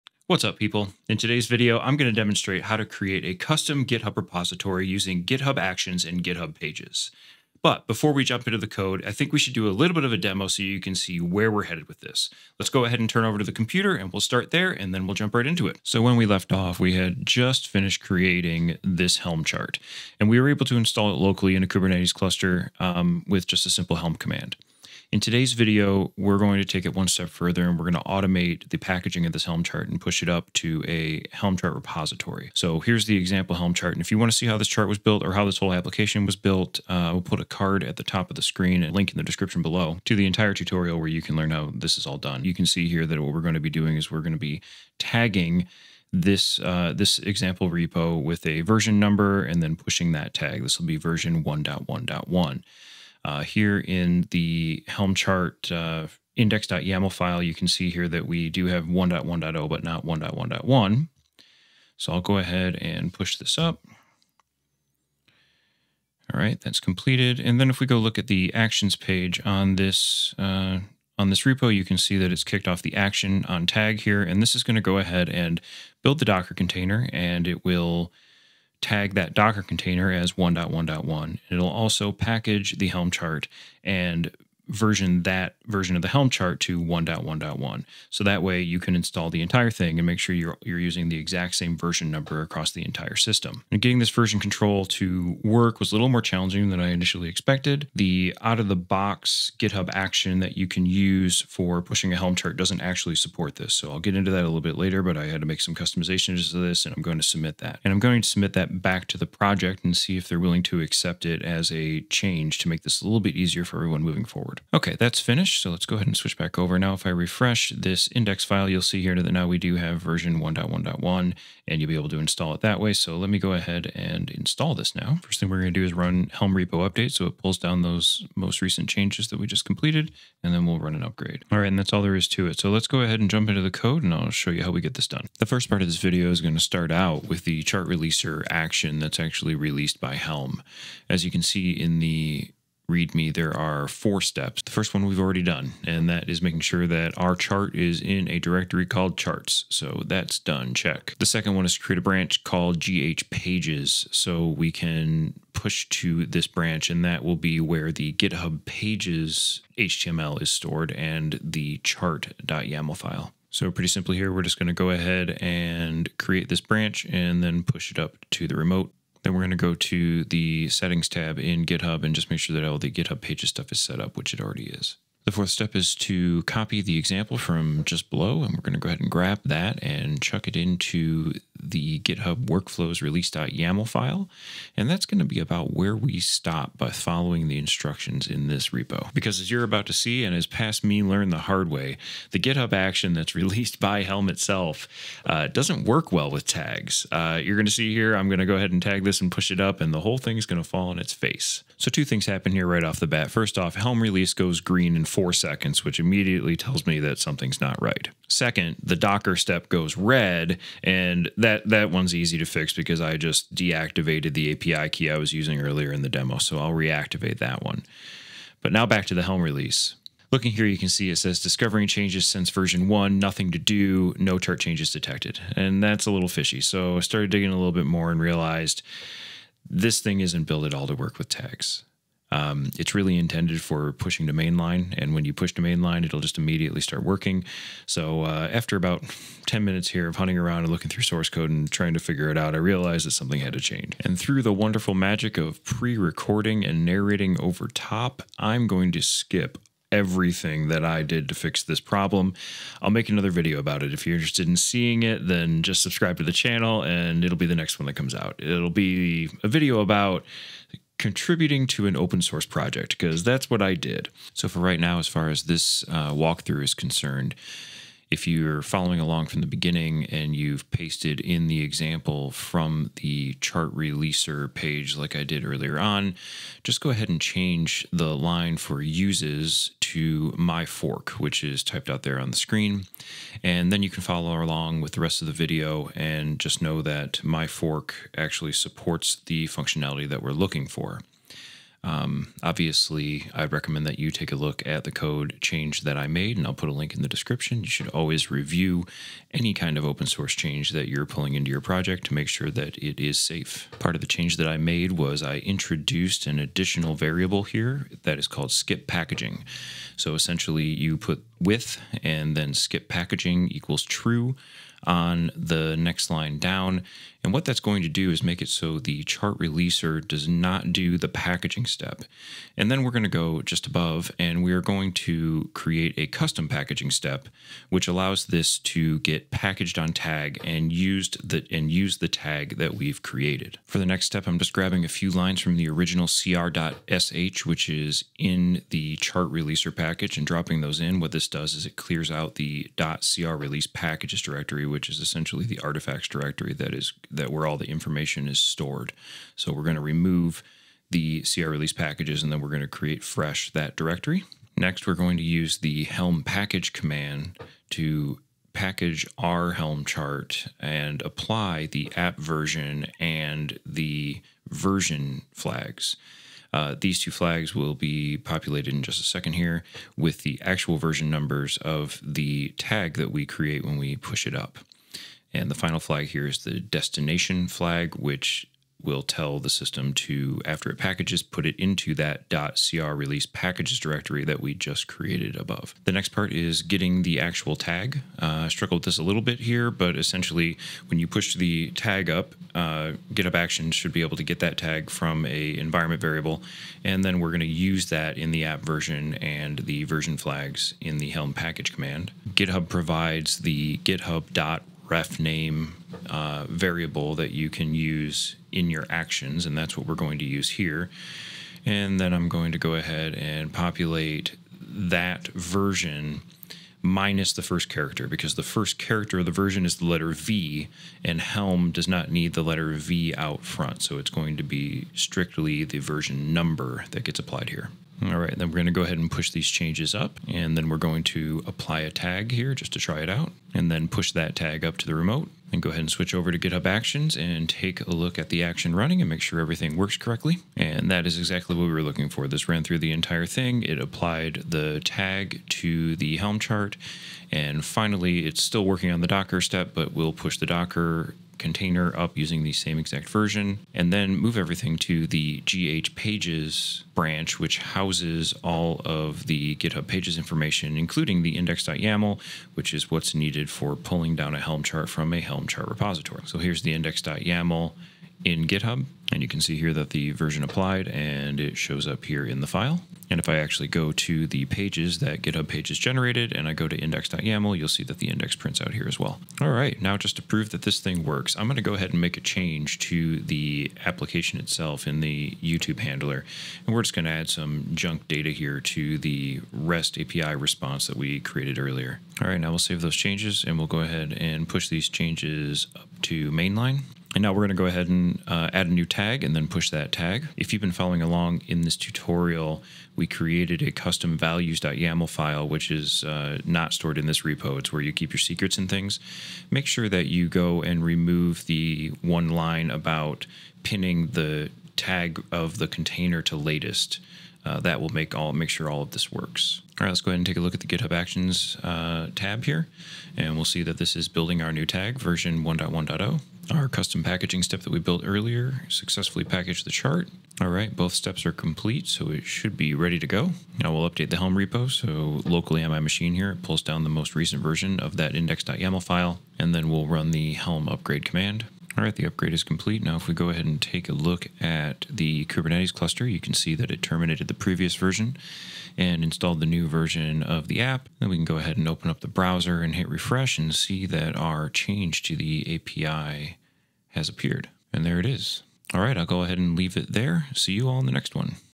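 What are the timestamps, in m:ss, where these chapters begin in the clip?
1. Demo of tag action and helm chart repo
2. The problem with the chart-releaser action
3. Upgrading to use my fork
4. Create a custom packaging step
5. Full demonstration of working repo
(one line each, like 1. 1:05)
1. 0:15
2. 3:04
3. 4:24
4. 5:22
5. 7:59.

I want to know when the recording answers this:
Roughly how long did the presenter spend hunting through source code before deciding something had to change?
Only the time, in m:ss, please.
3:59.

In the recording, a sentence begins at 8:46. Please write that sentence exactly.
Our custom packaging step that we built earlier successfully packaged the chart.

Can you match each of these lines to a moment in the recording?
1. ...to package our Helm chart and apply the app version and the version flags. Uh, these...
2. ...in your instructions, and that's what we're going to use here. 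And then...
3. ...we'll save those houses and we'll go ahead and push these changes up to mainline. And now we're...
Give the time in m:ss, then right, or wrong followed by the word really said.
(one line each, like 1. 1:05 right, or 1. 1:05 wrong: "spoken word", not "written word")
1. 5:57 right
2. 6:48 wrong: "actions", not "instructions"
3. 8:12 wrong: "changes", not "houses".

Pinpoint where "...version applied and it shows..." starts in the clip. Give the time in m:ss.
7:50.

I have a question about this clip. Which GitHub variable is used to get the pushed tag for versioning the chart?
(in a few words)
github.refname.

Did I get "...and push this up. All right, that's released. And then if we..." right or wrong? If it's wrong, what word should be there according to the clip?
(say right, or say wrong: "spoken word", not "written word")
wrong: "completed", not "released".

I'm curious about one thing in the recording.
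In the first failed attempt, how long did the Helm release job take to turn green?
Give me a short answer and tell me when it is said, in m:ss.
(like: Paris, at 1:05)
4 seconds, at 3:25.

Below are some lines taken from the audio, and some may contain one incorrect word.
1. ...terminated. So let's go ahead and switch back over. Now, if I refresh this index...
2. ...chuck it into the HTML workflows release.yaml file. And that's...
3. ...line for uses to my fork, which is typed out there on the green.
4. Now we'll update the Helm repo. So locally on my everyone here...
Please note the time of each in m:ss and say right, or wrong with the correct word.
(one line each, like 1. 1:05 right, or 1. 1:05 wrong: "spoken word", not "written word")
1. 1:55 wrong: "finished", not "terminated"
2. 3:00 wrong: "GitHub", not "HTML"
3. 4:38 wrong: "screen", not "green"
4. 8:53 wrong: "machine", not "everyone".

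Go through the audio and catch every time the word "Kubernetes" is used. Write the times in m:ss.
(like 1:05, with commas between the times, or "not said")
0:21, 9:05.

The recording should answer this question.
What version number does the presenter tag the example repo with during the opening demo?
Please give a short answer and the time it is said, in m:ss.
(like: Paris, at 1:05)
1.1.1, at 0:50.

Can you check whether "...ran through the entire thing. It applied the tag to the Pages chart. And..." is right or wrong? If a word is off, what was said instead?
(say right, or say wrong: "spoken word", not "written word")
wrong: "Helm", not "Pages".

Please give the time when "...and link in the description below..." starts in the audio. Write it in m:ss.
0:38.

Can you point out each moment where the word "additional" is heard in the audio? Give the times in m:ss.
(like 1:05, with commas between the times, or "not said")
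5:06.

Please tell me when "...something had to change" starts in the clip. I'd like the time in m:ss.
4:03.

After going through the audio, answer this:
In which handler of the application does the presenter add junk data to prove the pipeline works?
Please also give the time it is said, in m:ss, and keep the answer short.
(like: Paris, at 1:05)
YouTube handler, at 8:05.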